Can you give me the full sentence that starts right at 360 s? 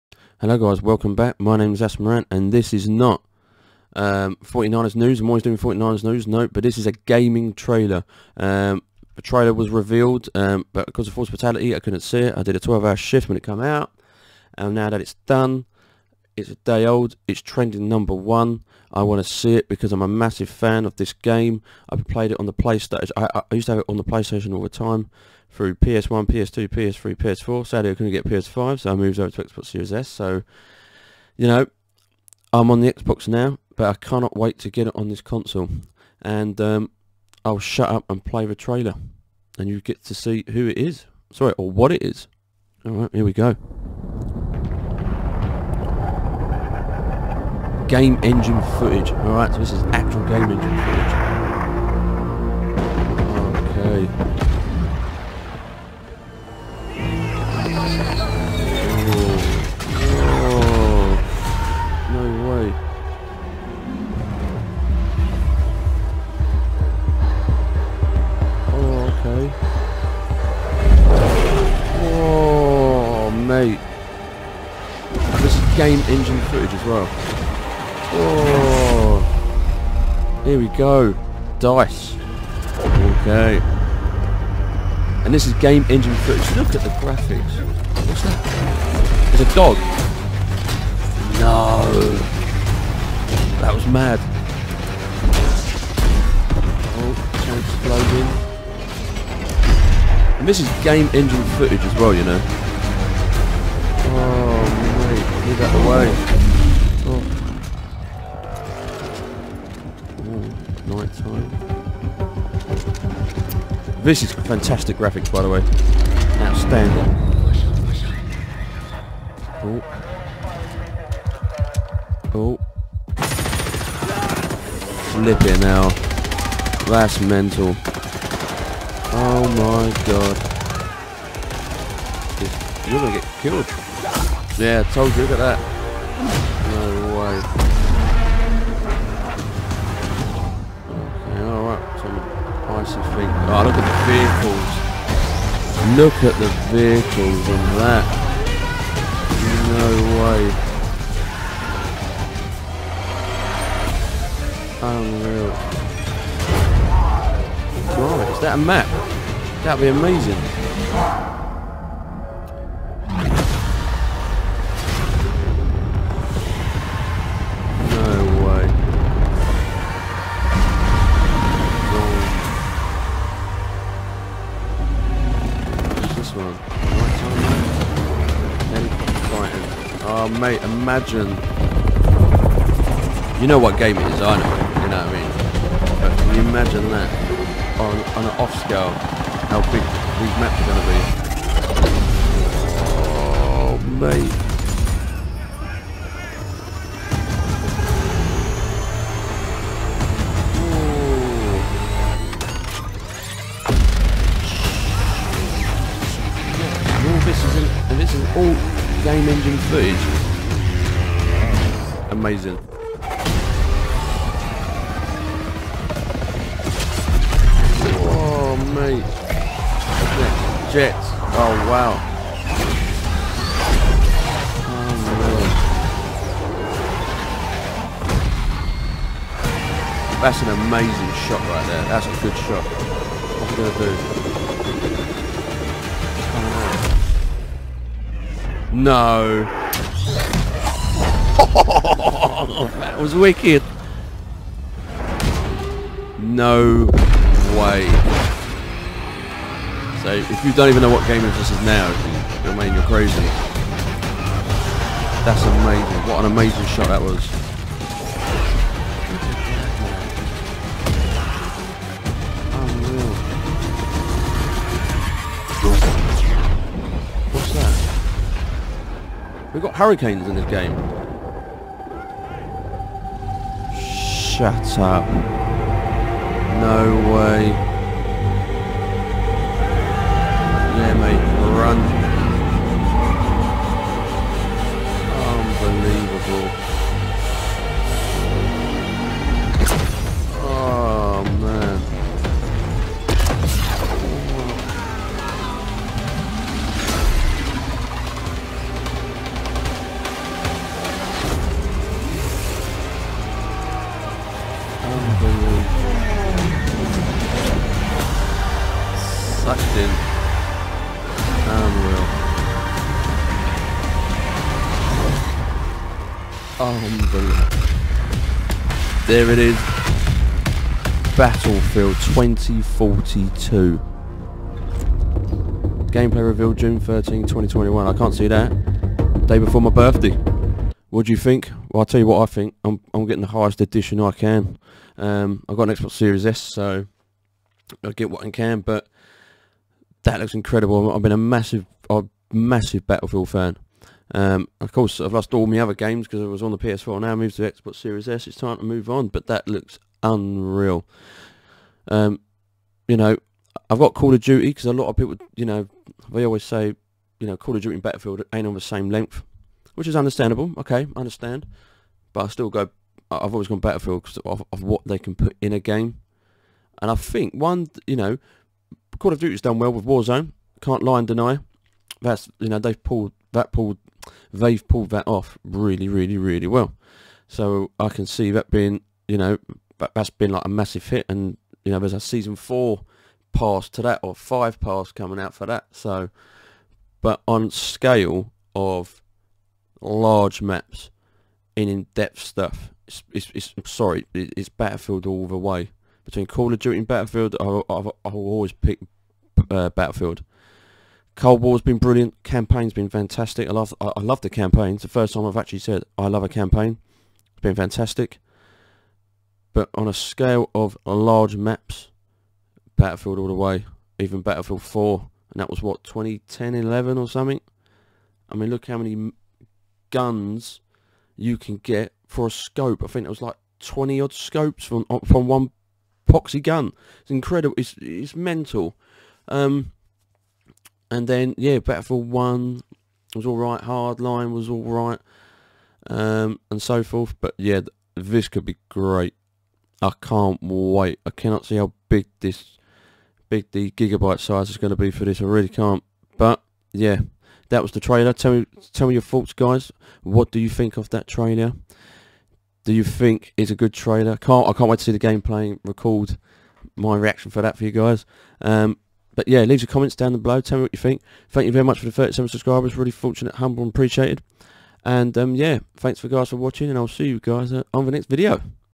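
Okay, I understand, but I still go.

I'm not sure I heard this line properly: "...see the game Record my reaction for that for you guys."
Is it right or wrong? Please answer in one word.
right.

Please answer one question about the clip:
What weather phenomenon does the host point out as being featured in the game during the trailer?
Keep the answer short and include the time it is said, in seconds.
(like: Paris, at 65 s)
hurricanes, at 269 s.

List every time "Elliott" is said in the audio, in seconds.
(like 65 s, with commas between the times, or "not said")
not said.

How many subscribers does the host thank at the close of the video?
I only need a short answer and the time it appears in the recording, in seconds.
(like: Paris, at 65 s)
37, at 461 s.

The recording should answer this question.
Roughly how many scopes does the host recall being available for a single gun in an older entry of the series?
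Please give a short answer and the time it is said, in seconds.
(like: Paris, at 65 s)
20 odd, at 423 s.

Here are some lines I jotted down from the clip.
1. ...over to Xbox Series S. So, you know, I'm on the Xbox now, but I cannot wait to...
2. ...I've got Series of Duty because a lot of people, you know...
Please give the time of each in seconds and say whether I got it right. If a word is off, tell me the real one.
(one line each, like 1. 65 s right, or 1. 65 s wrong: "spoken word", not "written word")
1. 29 s right
2. 353 s wrong: "Call", not "Series".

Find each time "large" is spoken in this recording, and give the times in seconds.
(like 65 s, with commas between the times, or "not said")
389 s, 410 s.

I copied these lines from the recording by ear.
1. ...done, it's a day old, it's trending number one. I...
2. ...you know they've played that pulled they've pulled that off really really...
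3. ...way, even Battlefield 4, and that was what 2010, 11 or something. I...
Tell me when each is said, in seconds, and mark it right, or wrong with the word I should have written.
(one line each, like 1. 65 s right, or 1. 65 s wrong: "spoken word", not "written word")
1. 15 s right
2. 372 s wrong: "pulled", not "played"
3. 413 s right.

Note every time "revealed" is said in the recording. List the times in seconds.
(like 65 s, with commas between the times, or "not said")
9 s, 326 s.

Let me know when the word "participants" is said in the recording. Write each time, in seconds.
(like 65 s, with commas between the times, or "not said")
not said.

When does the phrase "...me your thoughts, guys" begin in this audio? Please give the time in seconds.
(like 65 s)
448 s.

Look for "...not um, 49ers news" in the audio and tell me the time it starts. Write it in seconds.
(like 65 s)
2 s.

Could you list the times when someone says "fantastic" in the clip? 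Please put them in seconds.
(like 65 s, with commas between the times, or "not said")
114 s, 402 s, 407 s.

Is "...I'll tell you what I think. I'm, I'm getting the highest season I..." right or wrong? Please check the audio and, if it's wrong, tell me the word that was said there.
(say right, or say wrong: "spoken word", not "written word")
wrong: "edition", not "season".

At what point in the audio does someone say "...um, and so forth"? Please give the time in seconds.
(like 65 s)
435 s.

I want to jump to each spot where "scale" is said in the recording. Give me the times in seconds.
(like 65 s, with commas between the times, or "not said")
188 s, 387 s, 409 s.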